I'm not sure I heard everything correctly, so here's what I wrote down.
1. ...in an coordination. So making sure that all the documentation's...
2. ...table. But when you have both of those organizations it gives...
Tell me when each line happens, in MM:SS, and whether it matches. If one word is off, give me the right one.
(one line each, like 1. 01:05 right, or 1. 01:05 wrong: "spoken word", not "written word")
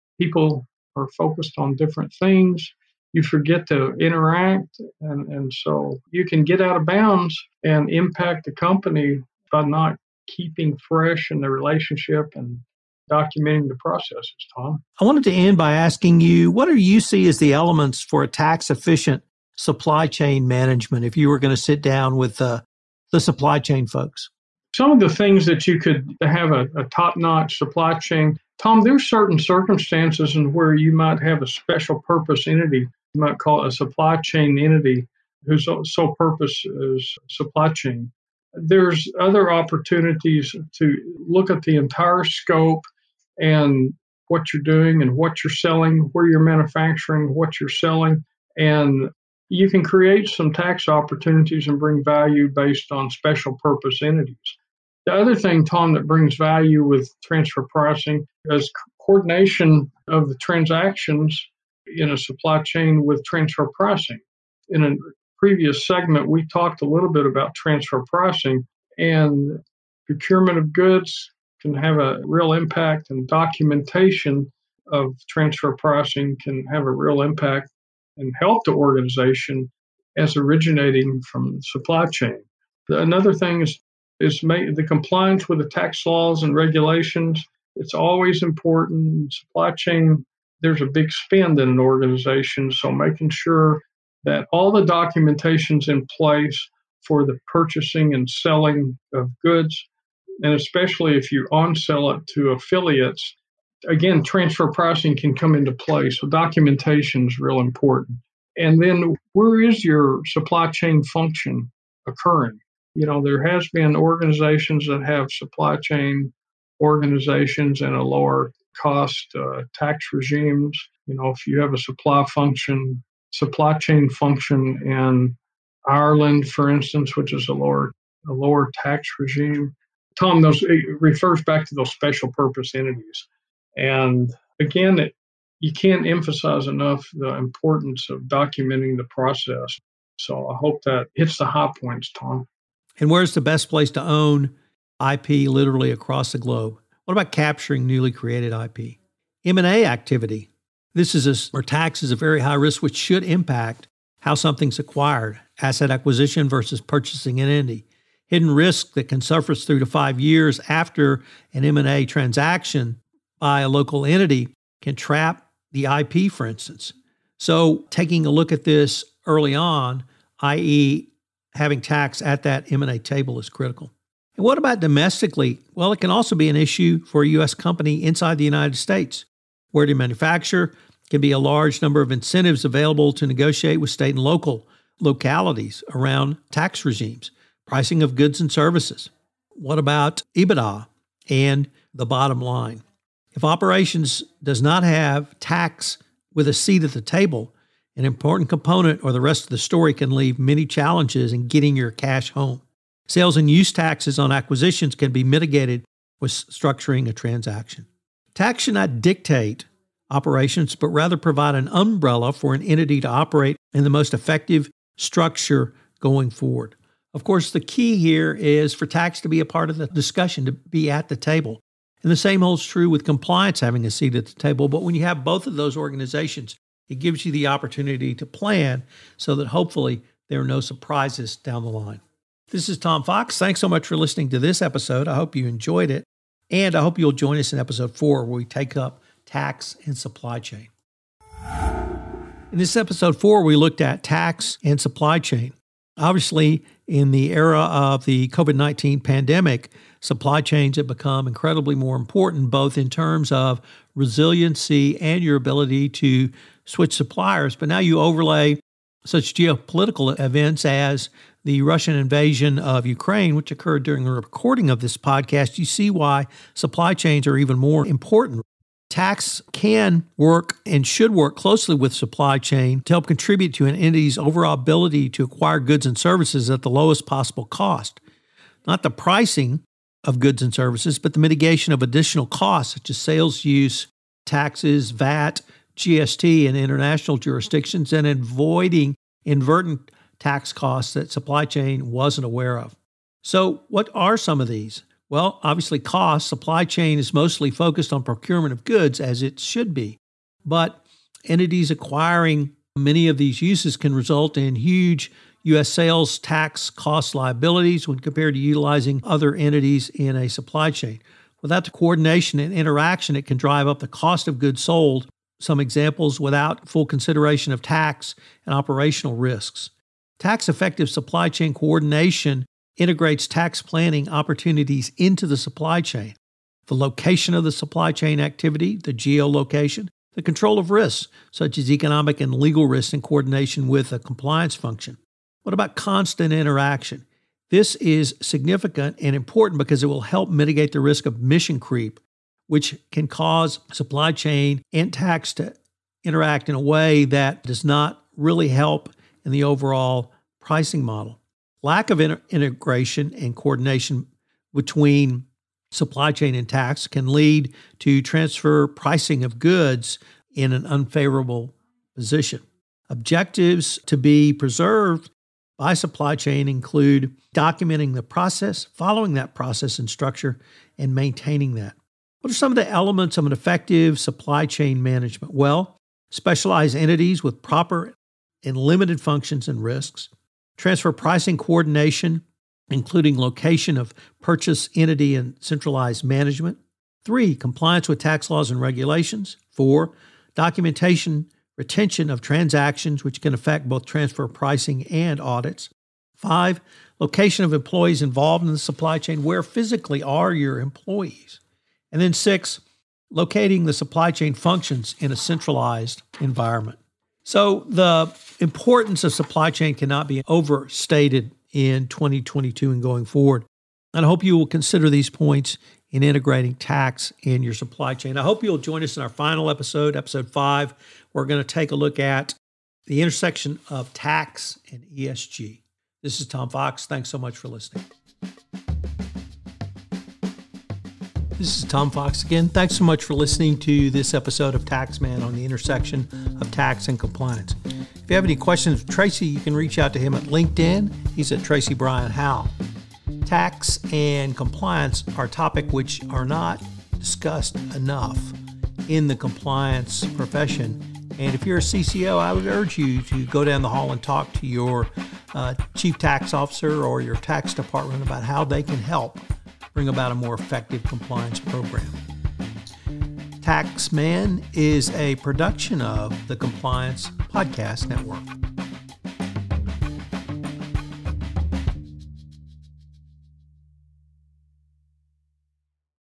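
1. 01:31 wrong: "organization", not "coordination"
2. 03:44 right.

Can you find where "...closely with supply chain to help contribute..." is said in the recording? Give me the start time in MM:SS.
04:31.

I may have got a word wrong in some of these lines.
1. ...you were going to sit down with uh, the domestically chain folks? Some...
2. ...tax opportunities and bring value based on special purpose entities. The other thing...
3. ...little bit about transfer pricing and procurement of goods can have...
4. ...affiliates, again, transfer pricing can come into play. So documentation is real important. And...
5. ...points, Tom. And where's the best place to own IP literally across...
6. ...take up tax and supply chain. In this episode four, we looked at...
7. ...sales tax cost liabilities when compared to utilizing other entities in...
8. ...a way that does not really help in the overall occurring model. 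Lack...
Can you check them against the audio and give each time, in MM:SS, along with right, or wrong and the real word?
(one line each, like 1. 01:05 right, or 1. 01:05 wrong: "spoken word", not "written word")
1. 00:21 wrong: "supply", not "domestically"
2. 00:50 right
3. 01:06 right
4. 01:42 right
5. 02:21 right
6. 03:58 right
7. 05:05 right
8. 05:46 wrong: "pricing", not "occurring".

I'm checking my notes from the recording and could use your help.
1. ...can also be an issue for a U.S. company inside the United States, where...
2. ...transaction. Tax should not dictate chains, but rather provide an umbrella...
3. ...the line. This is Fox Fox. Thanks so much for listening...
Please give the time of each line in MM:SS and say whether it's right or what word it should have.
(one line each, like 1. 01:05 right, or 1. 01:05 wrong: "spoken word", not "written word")
1. 02:56 right
2. 03:27 wrong: "operations", not "chains"
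3. 03:51 wrong: "Tom", not "Fox".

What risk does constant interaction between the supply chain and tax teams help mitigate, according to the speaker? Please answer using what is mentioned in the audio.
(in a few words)
mission creep.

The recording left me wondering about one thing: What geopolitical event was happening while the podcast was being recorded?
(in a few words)
Russian invasion of Ukraine.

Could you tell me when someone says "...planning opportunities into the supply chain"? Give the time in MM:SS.
05:23.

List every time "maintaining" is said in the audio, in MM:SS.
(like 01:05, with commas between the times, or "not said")
06:10.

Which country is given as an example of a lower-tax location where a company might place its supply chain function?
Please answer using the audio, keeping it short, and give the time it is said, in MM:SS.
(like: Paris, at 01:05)
Ireland, at 02:05.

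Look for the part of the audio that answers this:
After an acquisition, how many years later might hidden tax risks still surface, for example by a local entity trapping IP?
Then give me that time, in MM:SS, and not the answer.
02:39.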